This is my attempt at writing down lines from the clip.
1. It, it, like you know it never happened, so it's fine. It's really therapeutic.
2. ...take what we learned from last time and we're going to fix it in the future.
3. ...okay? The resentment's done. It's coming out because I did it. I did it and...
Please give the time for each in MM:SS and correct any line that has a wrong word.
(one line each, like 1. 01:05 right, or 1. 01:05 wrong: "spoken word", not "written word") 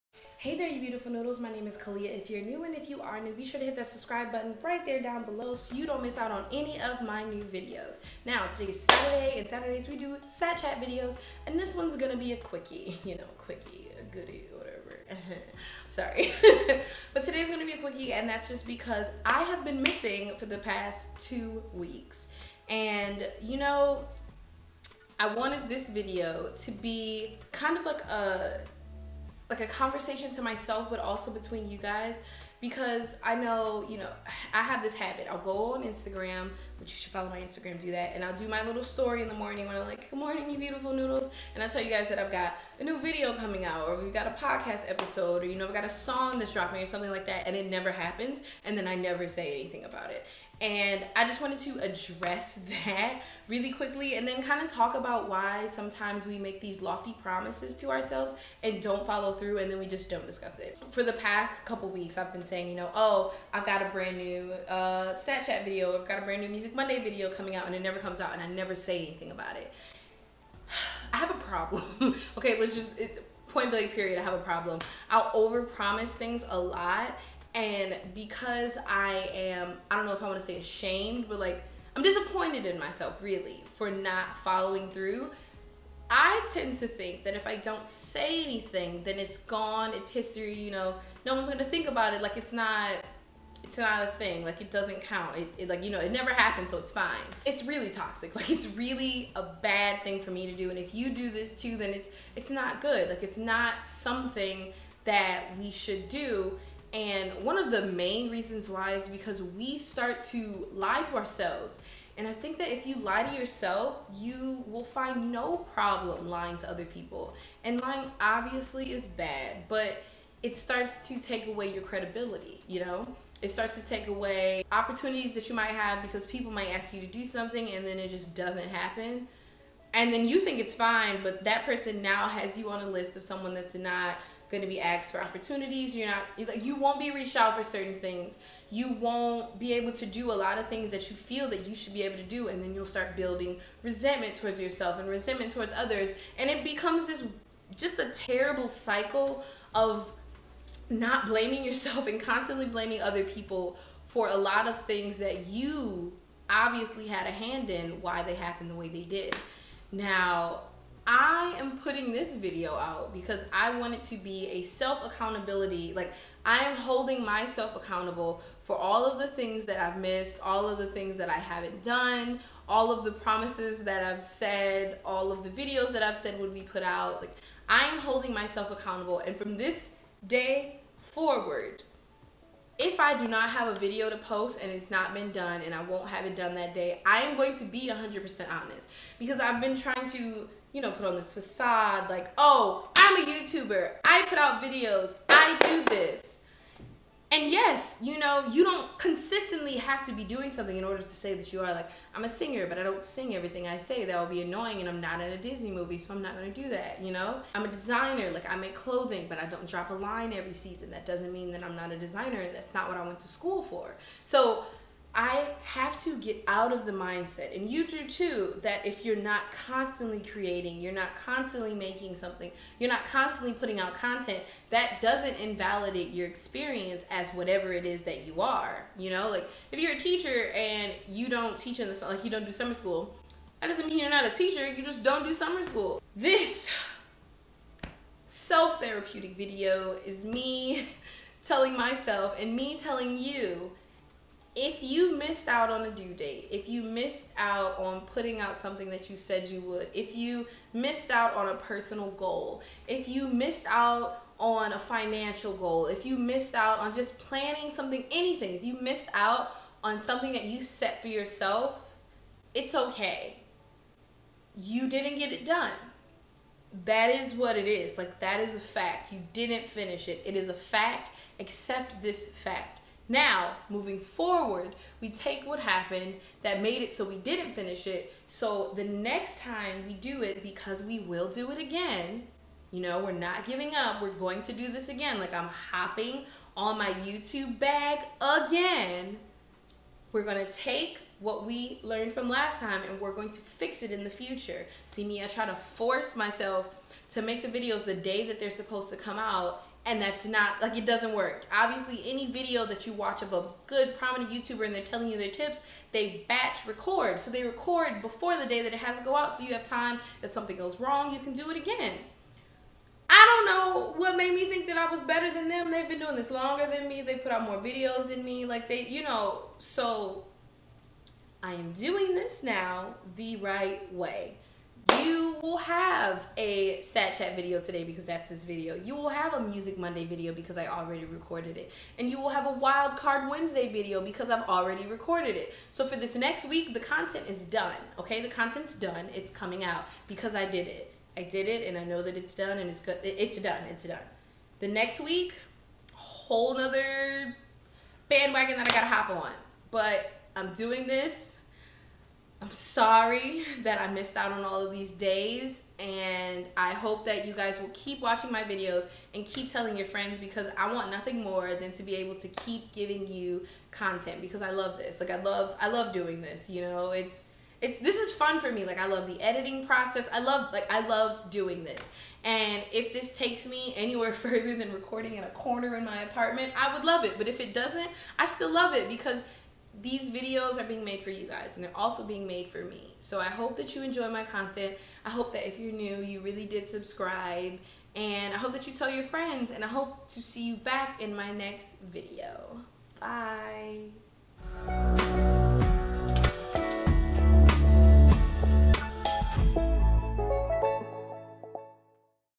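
1. 01:35 wrong: "toxic", not "therapeutic"
2. 04:50 right
3. 05:37 wrong: "content", not "resentment".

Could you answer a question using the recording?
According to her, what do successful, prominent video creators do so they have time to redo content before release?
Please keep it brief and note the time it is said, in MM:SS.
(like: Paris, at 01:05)
batch record, at 05:06.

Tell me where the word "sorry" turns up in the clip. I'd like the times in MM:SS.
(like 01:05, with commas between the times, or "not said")
00:15, 05:52.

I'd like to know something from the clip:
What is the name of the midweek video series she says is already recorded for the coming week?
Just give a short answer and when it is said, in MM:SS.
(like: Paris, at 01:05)
Wild Card Wednesday, at 05:32.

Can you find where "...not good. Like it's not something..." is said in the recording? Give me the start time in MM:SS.
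01:42.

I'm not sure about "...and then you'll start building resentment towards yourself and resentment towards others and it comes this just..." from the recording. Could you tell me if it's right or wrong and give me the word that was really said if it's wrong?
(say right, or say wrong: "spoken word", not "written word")
wrong: "becomes", not "comes".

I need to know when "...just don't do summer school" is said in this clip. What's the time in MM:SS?
03:54.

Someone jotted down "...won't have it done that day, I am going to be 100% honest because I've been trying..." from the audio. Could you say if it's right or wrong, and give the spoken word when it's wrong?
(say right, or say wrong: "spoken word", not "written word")
right.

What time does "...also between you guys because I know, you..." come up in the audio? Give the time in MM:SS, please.
00:30.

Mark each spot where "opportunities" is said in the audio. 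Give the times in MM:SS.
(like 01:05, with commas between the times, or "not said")
02:04, 02:15.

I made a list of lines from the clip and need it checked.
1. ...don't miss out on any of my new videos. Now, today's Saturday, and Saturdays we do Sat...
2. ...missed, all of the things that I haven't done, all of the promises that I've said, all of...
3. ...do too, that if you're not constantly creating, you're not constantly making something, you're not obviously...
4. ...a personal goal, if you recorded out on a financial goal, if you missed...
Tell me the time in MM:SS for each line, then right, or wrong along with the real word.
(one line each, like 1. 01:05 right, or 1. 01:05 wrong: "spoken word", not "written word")
1. 00:05 right
2. 02:49 right
3. 03:37 wrong: "constantly", not "obviously"
4. 04:11 wrong: "missed", not "recorded".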